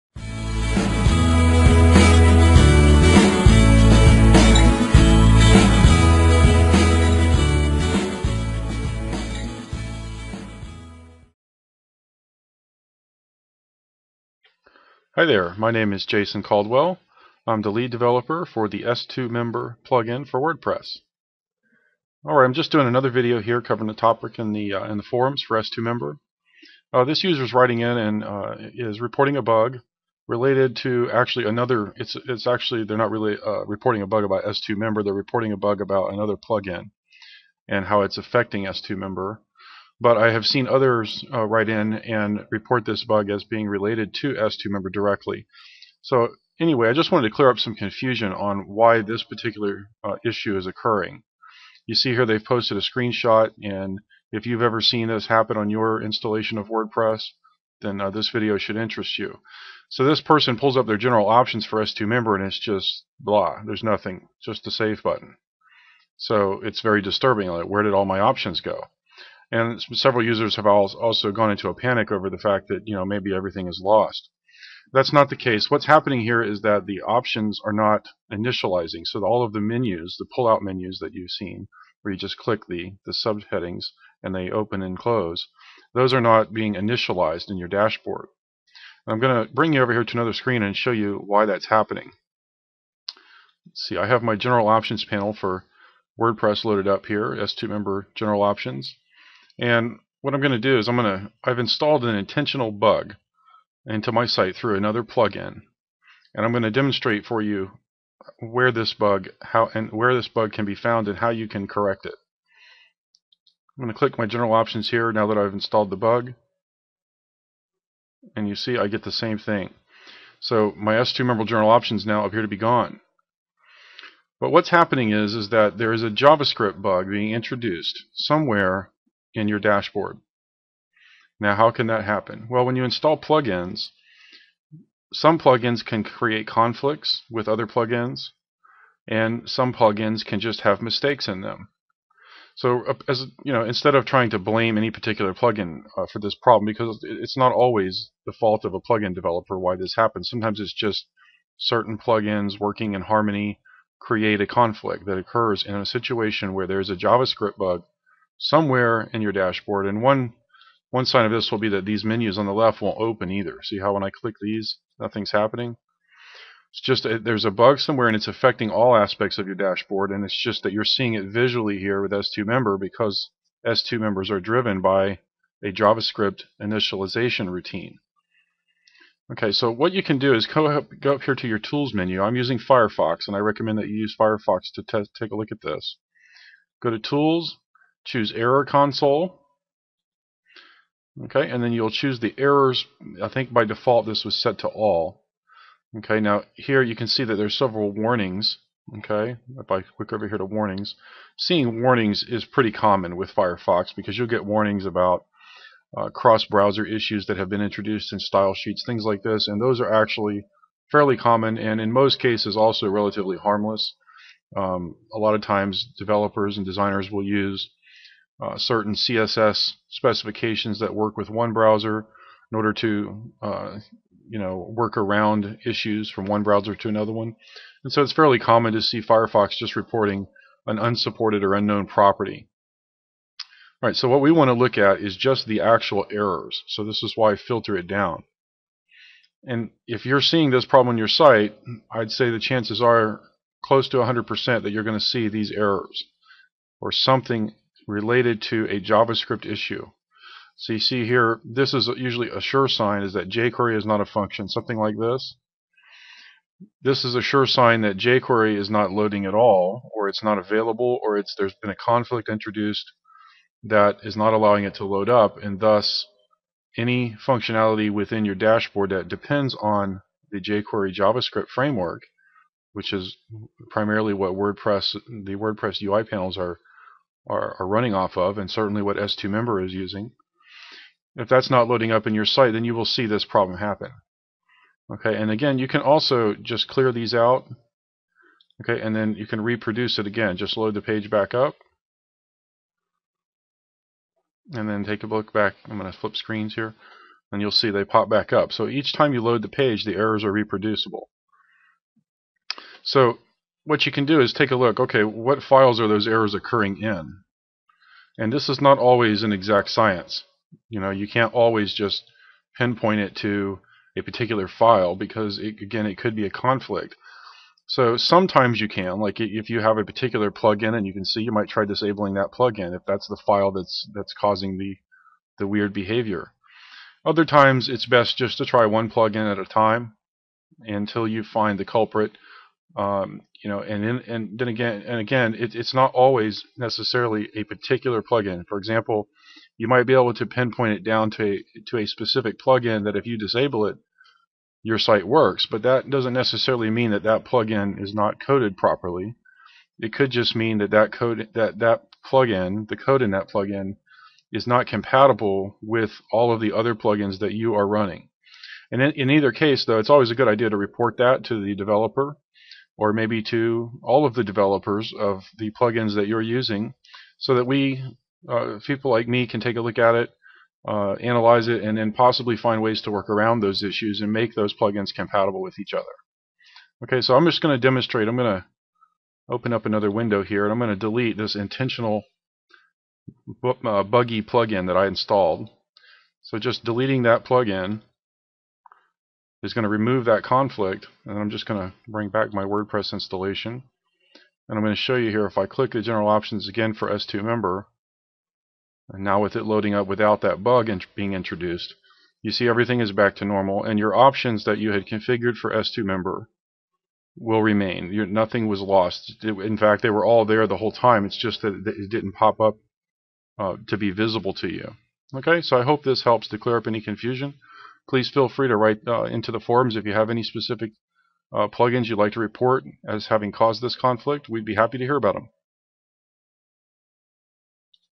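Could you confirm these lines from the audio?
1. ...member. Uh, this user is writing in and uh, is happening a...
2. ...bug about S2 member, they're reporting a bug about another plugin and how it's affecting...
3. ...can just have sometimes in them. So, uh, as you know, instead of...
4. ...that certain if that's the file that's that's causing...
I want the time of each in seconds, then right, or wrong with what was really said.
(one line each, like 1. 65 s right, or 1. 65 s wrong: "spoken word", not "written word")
1. 25 s wrong: "reporting", not "happening"
2. 34 s right
3. 140 s wrong: "mistakes", not "sometimes"
4. 322 s wrong: "plugin", not "certain".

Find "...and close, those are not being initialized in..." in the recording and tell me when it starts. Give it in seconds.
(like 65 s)
84 s.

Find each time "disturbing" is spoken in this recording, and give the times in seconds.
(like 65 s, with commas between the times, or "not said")
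67 s.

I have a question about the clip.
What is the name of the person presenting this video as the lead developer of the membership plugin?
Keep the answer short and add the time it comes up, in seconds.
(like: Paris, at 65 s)
Jason Caldwell, at 16 s.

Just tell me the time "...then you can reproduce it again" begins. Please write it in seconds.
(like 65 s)
288 s.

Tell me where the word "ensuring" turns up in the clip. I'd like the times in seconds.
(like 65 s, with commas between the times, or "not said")
not said.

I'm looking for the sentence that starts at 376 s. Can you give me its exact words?
Okay, so I'm just going to demonstrate.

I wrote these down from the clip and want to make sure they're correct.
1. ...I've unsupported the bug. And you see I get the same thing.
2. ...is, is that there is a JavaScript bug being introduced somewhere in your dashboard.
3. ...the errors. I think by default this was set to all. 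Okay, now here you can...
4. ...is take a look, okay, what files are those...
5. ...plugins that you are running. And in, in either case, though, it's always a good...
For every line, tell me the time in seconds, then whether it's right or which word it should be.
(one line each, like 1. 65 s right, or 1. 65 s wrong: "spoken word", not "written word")
1. 115 s wrong: "installed", not "unsupported"
2. 125 s right
3. 192 s right
4. 304 s right
5. 356 s right.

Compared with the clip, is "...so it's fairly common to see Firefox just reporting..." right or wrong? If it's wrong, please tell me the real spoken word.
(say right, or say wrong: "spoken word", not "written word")
right.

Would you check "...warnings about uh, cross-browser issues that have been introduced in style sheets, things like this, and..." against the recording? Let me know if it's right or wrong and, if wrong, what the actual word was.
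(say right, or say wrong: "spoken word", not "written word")
right.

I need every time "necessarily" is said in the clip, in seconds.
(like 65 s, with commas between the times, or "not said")
336 s, 346 s.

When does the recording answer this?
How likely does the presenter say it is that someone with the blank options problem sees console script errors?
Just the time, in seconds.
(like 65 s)
243 s.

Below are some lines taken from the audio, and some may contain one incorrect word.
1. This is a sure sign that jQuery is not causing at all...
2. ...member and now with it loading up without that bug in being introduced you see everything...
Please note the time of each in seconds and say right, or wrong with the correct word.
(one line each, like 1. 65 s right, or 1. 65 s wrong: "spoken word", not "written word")
1. 256 s wrong: "loading", not "causing"
2. 397 s right.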